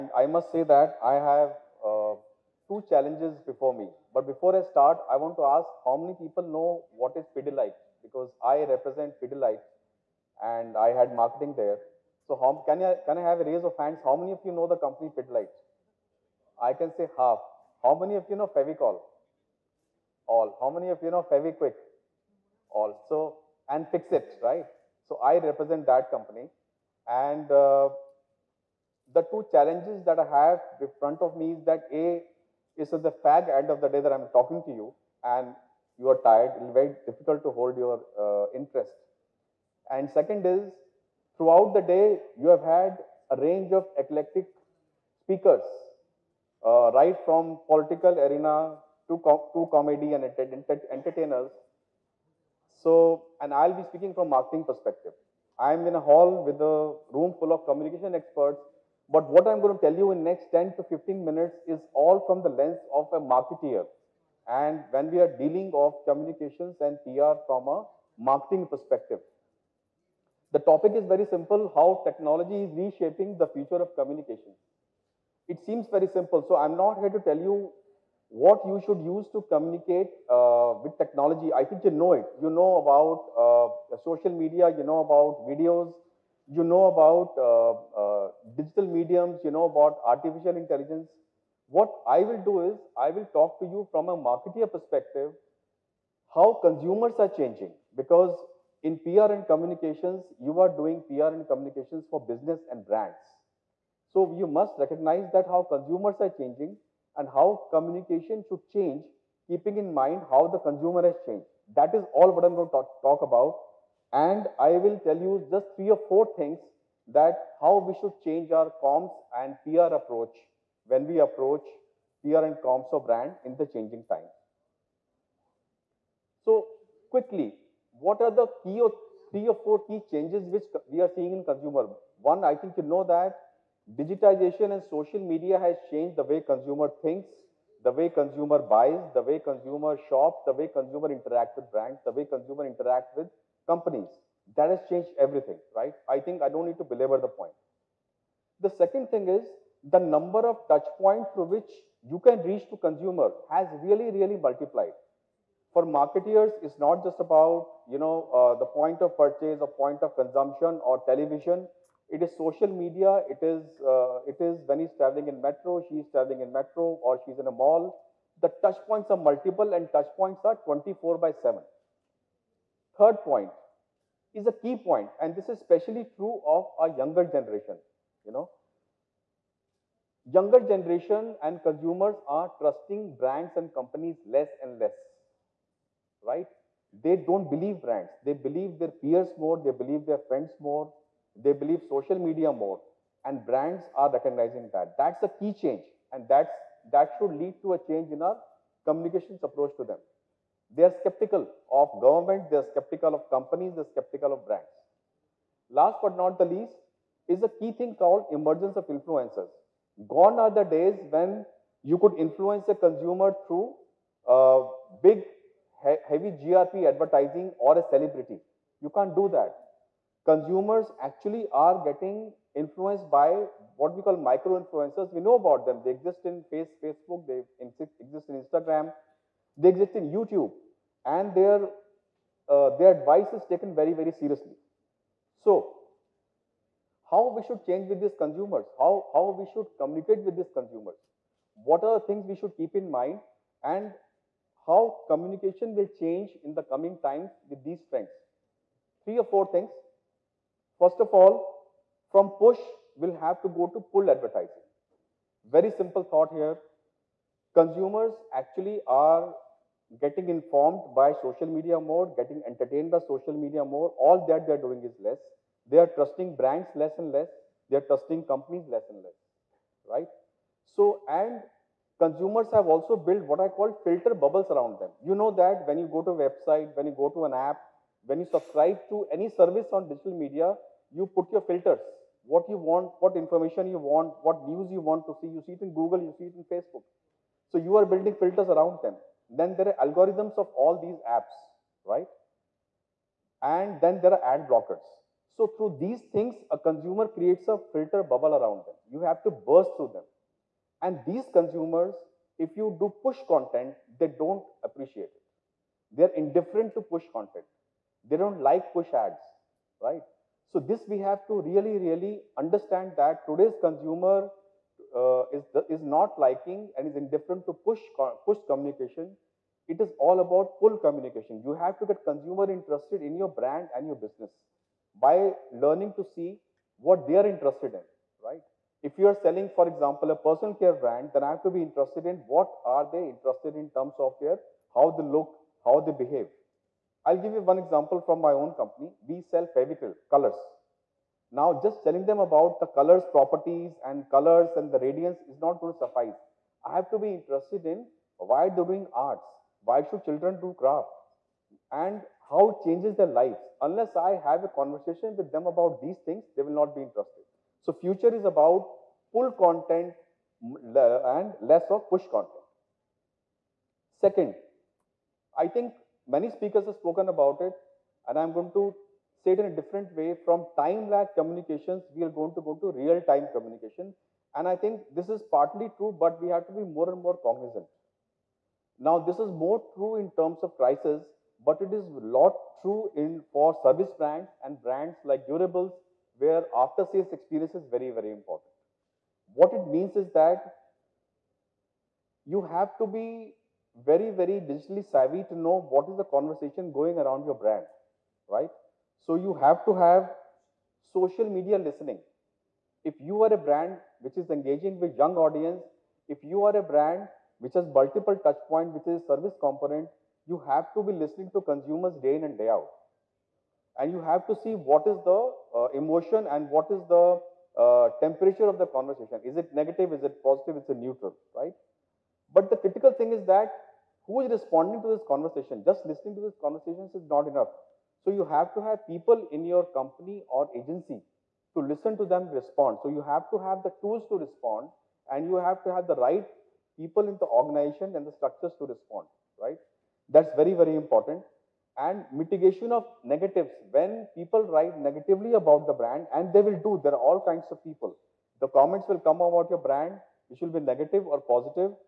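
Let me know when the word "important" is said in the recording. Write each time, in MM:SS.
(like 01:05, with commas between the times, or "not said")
06:28, 07:20.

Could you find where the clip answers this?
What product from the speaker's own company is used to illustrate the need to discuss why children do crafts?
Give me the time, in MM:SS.
05:39.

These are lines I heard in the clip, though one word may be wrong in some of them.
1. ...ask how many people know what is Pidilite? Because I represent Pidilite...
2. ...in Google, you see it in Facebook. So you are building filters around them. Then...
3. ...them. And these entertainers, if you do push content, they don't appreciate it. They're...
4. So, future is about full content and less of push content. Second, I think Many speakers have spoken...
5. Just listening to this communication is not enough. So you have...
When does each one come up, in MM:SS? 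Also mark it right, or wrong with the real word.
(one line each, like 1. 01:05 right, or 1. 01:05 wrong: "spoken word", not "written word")
1. 00:05 right
2. 04:45 right
3. 04:59 wrong: "consumers", not "entertainers"
4. 05:57 right
5. 07:05 wrong: "conversation", not "communication".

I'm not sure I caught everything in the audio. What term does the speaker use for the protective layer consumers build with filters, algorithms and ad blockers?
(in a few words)
filter bubbles.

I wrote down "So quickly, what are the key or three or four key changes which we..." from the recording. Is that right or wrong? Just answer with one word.
right.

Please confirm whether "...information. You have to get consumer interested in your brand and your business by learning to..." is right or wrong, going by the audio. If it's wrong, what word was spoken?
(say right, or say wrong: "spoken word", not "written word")
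wrong: "communication", not "information".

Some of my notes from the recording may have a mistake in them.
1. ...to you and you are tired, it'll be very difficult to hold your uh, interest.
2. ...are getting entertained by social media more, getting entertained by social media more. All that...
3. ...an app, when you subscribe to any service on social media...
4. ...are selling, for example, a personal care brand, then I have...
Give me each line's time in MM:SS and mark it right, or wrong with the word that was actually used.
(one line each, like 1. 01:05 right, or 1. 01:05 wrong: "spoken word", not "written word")
1. 00:34 right
2. 04:18 wrong: "informed", not "entertained"
3. 04:37 wrong: "digital", not "social"
4. 05:29 right.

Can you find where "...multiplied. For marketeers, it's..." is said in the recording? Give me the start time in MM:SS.
02:34.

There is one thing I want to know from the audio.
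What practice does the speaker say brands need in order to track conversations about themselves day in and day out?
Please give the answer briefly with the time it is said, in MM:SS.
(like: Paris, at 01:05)
social media listening, at 06:40.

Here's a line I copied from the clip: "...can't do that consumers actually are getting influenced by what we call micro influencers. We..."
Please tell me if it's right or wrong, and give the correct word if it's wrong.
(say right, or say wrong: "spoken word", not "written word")
right.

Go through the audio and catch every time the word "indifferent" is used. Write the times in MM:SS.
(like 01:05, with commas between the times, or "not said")
05:06, 05:16.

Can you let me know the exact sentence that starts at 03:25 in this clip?
Last but not the least is a key thing called emergence of influencers.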